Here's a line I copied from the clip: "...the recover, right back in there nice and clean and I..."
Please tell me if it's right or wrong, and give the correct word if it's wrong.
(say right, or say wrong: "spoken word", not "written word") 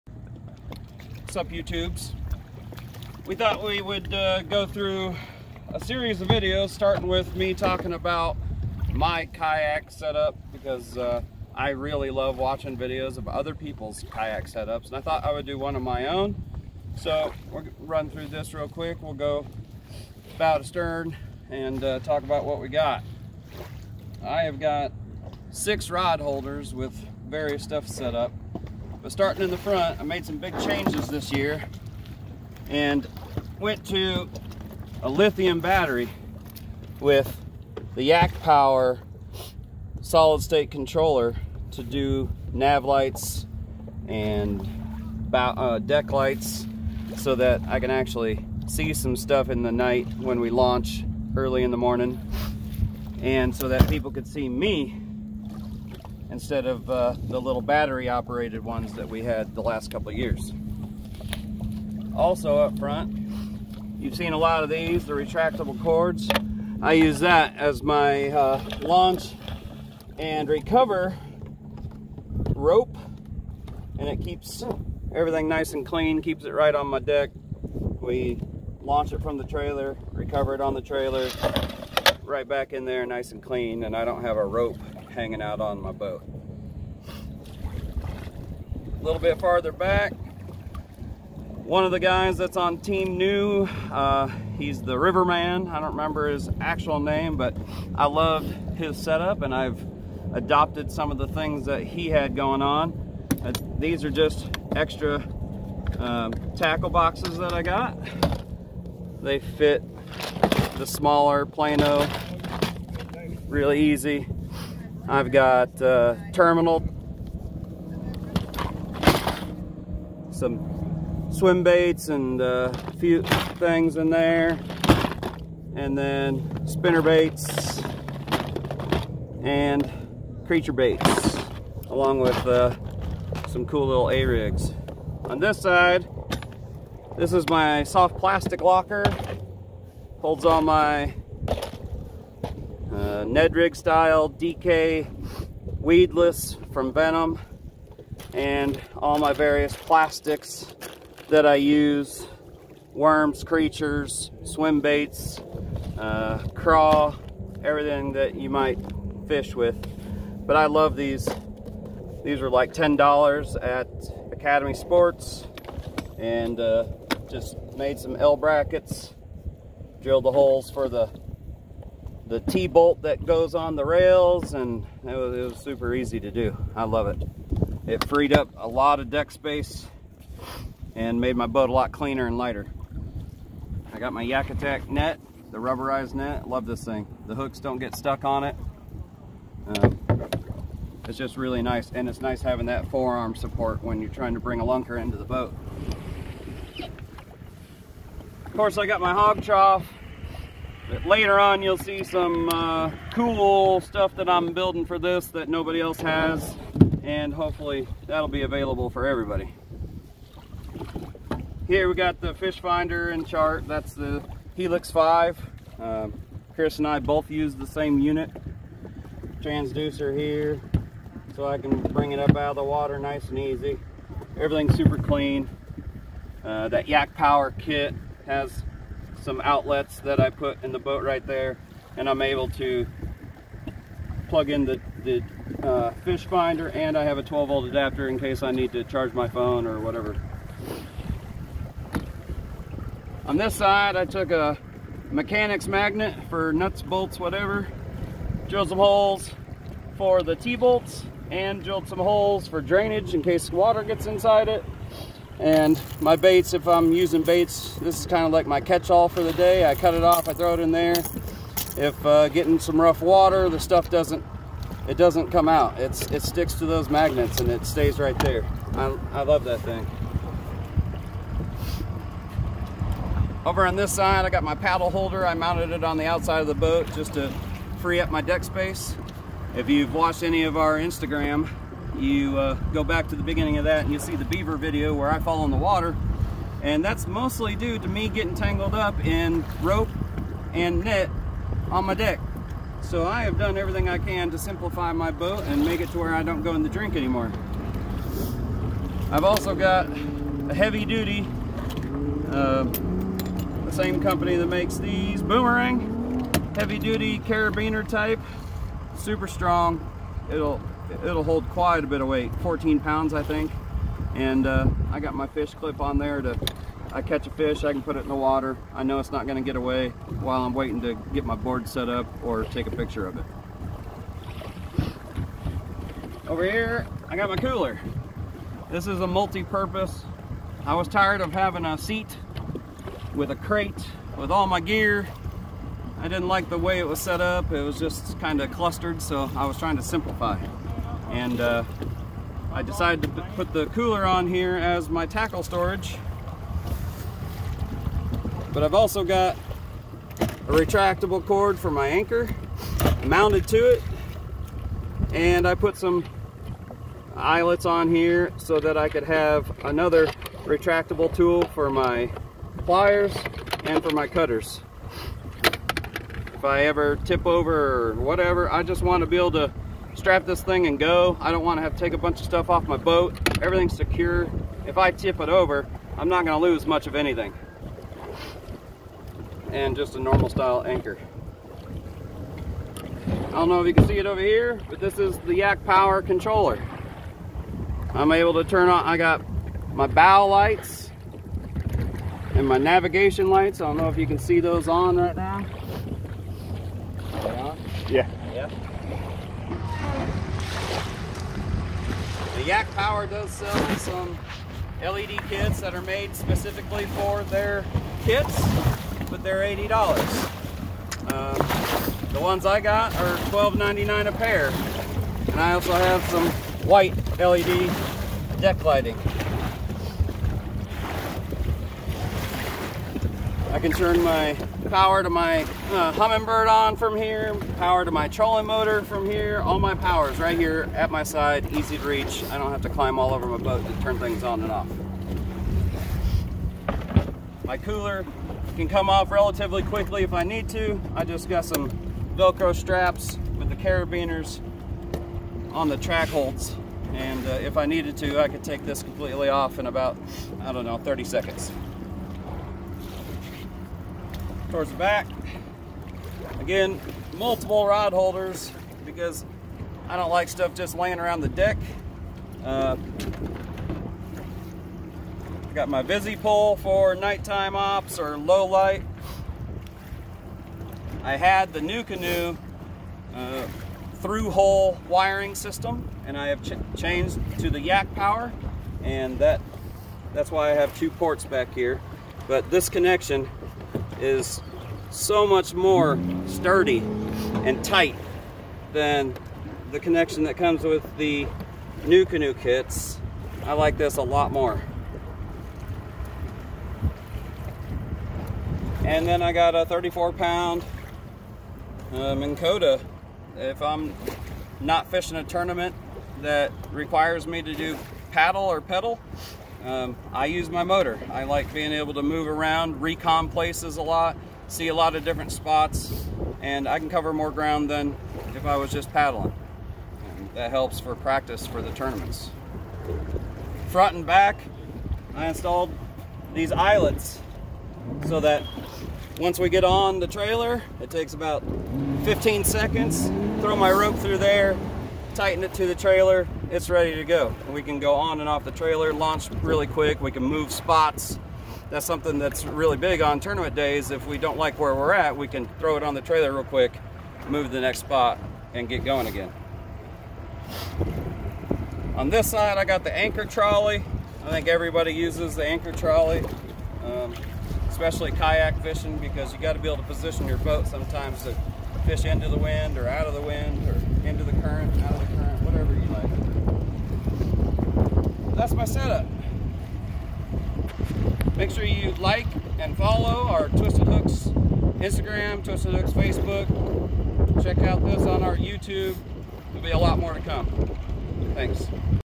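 wrong: "trailer", not "recover".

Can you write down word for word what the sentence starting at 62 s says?
Also up front, you've seen a lot of these, the retractable cords.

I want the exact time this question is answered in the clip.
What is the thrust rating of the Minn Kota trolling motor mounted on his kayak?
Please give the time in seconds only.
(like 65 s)
499 s.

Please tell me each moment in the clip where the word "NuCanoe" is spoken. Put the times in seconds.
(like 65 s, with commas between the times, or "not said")
471 s, 491 s.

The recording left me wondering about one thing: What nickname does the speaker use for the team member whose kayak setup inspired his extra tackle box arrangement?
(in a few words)
the Riverman.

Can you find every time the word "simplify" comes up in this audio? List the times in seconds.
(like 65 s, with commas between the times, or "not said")
294 s, 339 s.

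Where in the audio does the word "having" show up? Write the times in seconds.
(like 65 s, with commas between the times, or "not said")
192 s, 331 s.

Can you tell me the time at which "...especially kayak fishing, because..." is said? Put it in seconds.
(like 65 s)
557 s.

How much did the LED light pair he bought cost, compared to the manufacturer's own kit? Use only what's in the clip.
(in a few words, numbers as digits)
$12.99.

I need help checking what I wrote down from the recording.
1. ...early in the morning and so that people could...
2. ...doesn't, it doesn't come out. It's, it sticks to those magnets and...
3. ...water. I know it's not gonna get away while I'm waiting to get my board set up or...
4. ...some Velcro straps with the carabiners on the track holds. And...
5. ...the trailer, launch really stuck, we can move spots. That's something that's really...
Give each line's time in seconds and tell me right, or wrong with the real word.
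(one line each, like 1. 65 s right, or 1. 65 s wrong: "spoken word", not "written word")
1. 51 s right
2. 263 s right
3. 318 s right
4. 441 s right
5. 538 s wrong: "quick", not "stuck".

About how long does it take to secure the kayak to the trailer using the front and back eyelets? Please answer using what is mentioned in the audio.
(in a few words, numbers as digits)
15 seconds.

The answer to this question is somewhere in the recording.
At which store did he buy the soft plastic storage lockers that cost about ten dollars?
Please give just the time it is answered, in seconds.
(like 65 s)
164 s.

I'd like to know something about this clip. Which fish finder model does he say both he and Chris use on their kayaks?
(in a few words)
Helix 5.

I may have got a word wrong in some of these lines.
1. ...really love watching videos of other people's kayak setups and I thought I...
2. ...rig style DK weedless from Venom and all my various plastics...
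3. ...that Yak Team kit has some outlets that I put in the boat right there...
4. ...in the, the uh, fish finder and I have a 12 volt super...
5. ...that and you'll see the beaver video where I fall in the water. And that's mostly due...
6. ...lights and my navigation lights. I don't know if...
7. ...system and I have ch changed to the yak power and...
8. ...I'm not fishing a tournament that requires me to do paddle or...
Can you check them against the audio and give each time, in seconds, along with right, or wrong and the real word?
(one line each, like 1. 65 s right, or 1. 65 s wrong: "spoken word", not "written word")
1. 11 s right
2. 143 s right
3. 226 s wrong: "Power", not "Team"
4. 234 s wrong: "adapter", not "super"
5. 283 s right
6. 390 s right
7. 475 s right
8. 503 s right.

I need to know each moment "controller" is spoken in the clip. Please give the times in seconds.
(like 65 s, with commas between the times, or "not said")
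40 s, 386 s.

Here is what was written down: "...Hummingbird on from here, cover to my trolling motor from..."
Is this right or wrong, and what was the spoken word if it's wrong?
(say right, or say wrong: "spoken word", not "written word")
wrong: "power", not "cover".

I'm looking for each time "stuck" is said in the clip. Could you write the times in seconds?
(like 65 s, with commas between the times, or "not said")
187 s.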